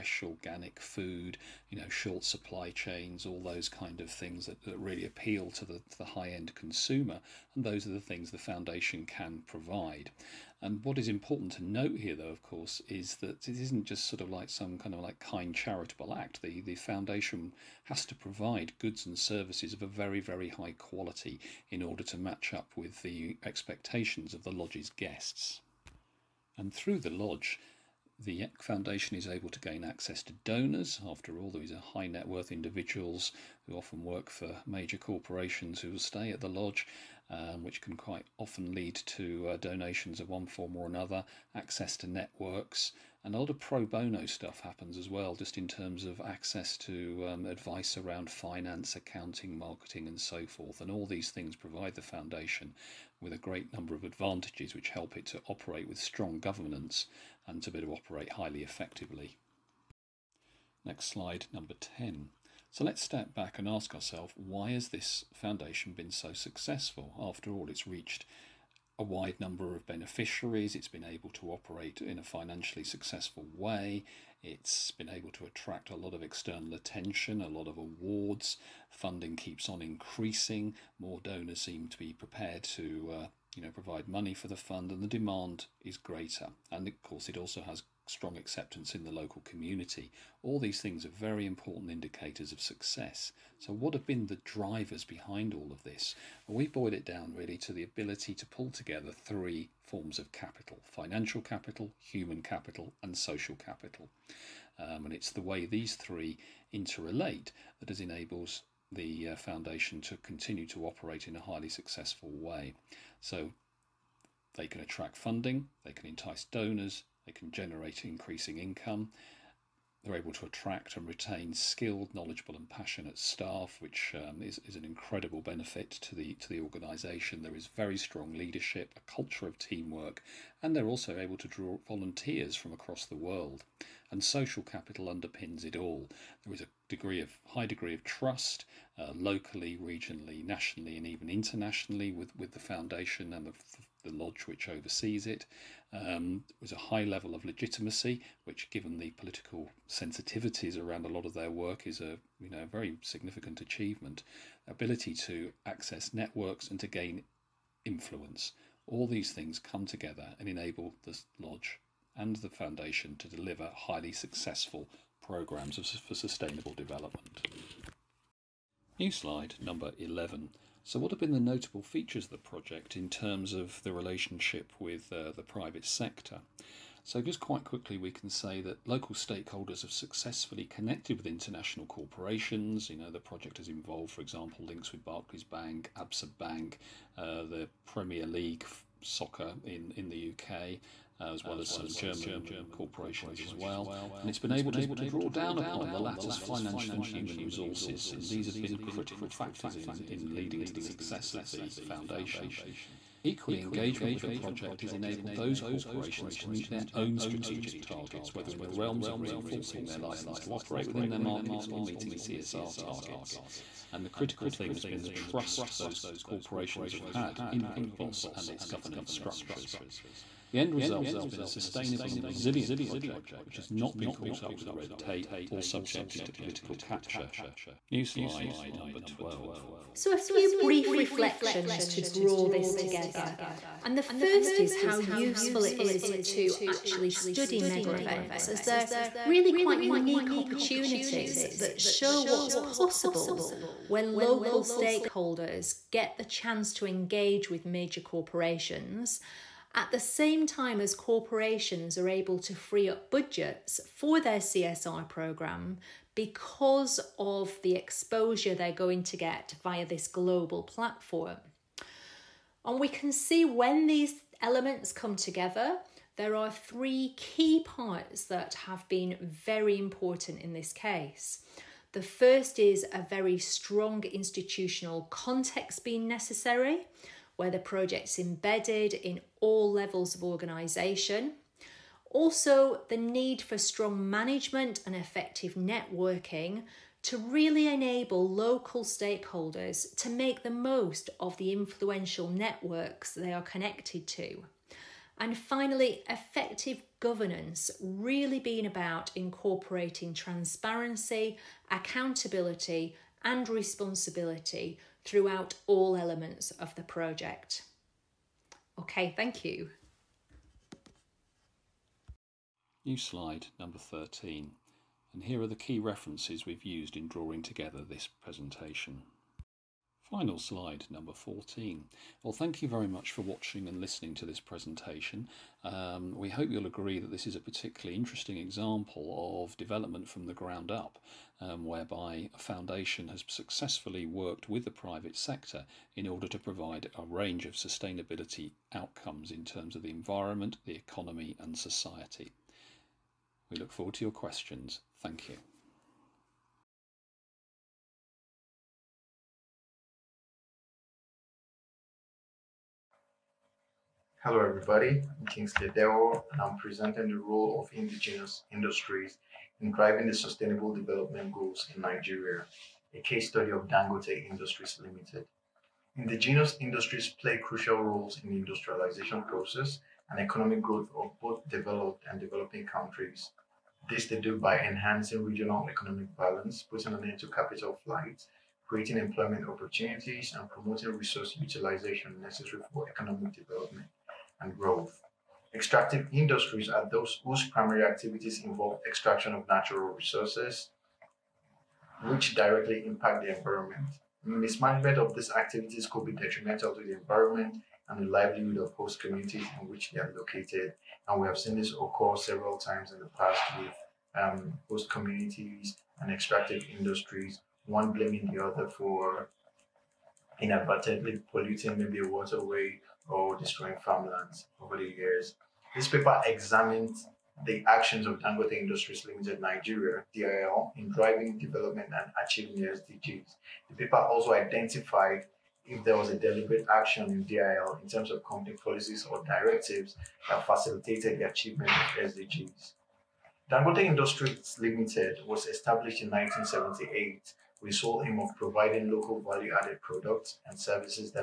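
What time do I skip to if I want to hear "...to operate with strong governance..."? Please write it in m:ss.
0:55.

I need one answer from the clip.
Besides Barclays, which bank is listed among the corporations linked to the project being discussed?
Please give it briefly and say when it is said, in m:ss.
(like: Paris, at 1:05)
Absa Bank, at 3:05.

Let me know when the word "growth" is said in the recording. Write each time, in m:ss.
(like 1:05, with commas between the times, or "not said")
6:10, 6:24.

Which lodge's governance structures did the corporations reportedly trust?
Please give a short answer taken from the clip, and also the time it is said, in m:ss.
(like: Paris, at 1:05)
Grootbos, at 3:37.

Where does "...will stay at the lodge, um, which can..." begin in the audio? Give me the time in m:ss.
0:35.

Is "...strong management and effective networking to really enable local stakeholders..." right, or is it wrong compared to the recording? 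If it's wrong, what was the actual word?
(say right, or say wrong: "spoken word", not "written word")
right.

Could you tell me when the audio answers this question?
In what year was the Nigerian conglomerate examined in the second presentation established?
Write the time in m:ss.
7:16.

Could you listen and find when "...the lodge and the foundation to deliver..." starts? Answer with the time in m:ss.
2:41.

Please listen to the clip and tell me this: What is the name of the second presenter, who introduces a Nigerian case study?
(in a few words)
Kingsley Dewo.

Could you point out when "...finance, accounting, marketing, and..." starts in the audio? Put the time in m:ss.
0:48.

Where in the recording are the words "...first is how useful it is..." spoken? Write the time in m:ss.
3:54.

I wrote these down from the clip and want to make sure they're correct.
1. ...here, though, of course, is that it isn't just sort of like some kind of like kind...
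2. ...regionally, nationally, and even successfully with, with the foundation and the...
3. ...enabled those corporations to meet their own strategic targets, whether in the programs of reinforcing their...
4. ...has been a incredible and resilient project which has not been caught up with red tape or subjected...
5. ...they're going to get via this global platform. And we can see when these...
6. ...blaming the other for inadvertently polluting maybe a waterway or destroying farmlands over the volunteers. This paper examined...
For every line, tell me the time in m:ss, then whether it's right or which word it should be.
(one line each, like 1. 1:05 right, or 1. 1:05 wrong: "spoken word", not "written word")
1. 0:11 right
2. 2:19 wrong: "internationally", not "successfully"
3. 3:24 wrong: "realms", not "programs"
4. 3:41 wrong: "sustainable", not "incredible"
5. 4:18 right
6. 6:47 wrong: "years", not "volunteers".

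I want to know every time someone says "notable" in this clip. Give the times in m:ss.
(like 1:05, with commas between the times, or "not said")
2:51.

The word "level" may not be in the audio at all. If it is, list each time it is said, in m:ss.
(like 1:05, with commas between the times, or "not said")
2:27, 4:39.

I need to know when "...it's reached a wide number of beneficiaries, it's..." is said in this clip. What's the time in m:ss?
1:07.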